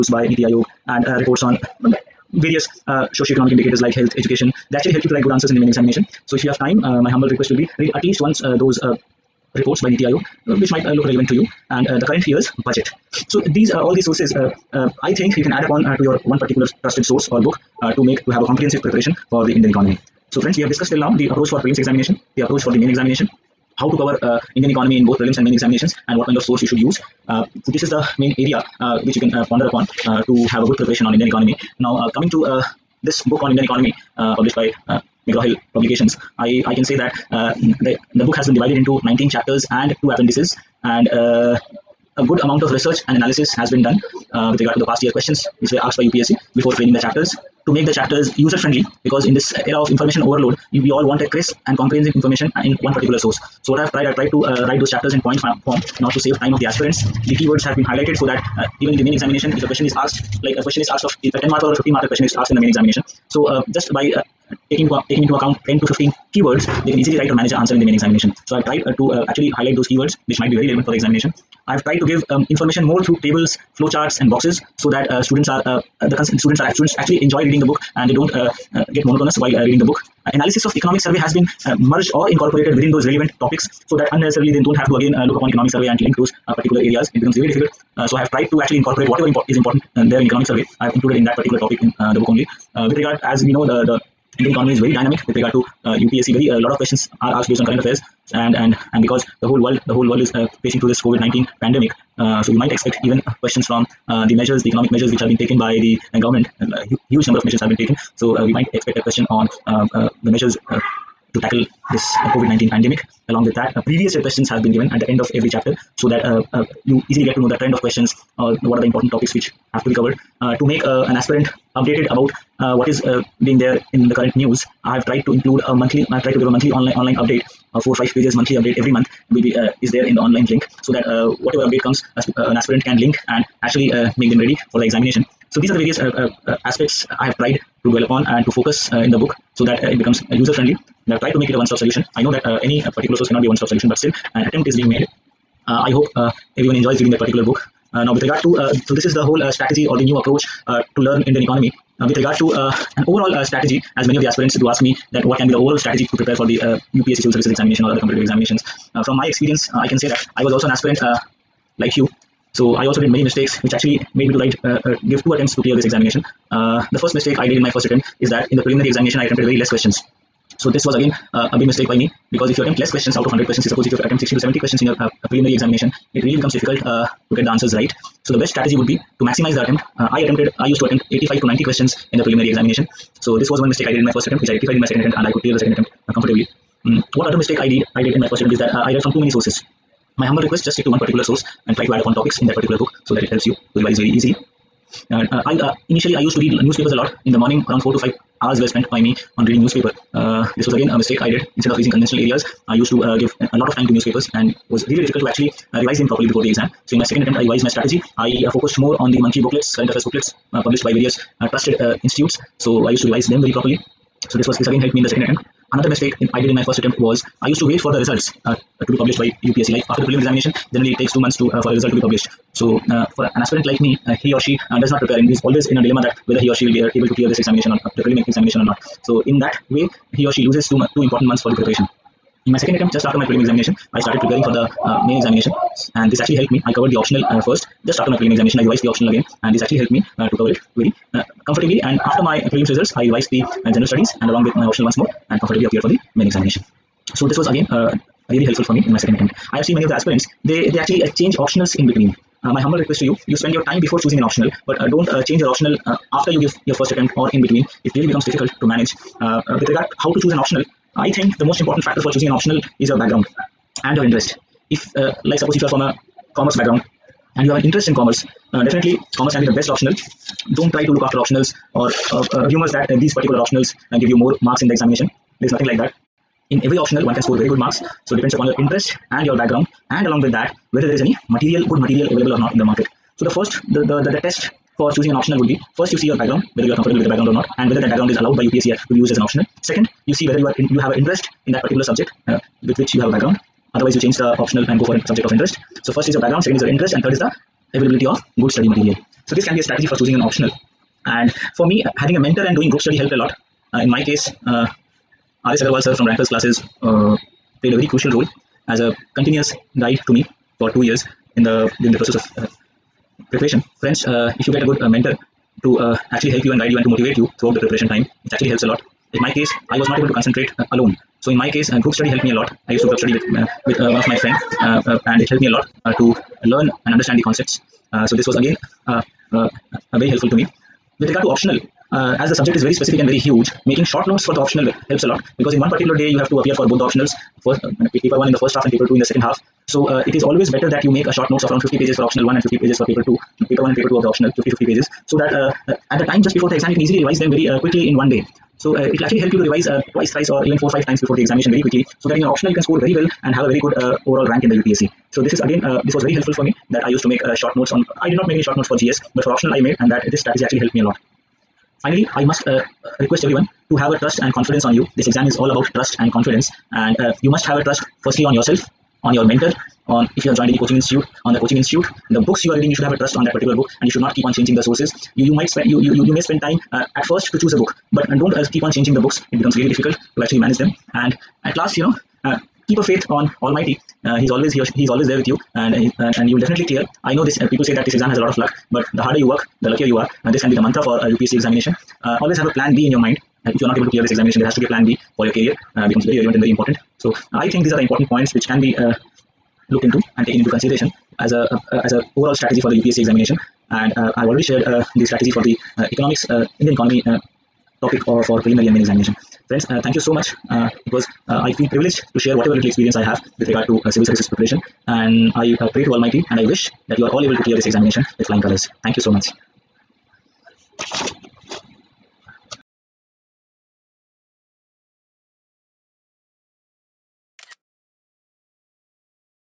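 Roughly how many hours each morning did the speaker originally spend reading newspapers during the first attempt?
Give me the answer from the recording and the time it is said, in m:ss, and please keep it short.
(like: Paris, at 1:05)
4 to 5 hours, at 3:17.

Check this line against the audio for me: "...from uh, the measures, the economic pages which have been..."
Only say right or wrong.
wrong.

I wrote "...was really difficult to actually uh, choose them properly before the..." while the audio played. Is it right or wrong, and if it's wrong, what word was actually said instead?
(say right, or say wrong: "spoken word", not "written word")
wrong: "revise", not "choose".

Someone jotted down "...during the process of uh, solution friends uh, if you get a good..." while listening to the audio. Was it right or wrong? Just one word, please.
wrong.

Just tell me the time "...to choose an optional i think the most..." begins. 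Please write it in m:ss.
4:20.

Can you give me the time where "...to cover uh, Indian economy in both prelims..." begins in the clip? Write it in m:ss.
0:23.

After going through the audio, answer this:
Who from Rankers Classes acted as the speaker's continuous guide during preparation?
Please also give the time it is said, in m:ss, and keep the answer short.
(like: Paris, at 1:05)
R.S. Agarwal, at 5:05.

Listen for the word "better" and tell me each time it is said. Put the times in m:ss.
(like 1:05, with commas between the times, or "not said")
5:40.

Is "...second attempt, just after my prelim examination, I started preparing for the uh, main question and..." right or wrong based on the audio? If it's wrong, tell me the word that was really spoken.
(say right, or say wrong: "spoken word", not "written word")
wrong: "examination", not "question".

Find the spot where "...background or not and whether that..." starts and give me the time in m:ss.
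4:47.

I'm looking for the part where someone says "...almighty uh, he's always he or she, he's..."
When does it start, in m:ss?
6:23.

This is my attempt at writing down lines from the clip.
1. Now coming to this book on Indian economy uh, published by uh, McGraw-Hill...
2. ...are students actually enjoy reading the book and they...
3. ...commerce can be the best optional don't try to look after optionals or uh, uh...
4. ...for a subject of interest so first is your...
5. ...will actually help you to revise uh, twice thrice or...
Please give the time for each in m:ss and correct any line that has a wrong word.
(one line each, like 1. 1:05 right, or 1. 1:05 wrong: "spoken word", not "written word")
1. 0:31 right
2. 1:16 right
3. 4:29 right
4. 4:54 right
5. 5:48 right.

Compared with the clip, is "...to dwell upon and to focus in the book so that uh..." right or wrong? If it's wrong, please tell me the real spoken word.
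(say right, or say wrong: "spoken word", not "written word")
right.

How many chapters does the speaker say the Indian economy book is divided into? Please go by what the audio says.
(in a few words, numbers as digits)
19.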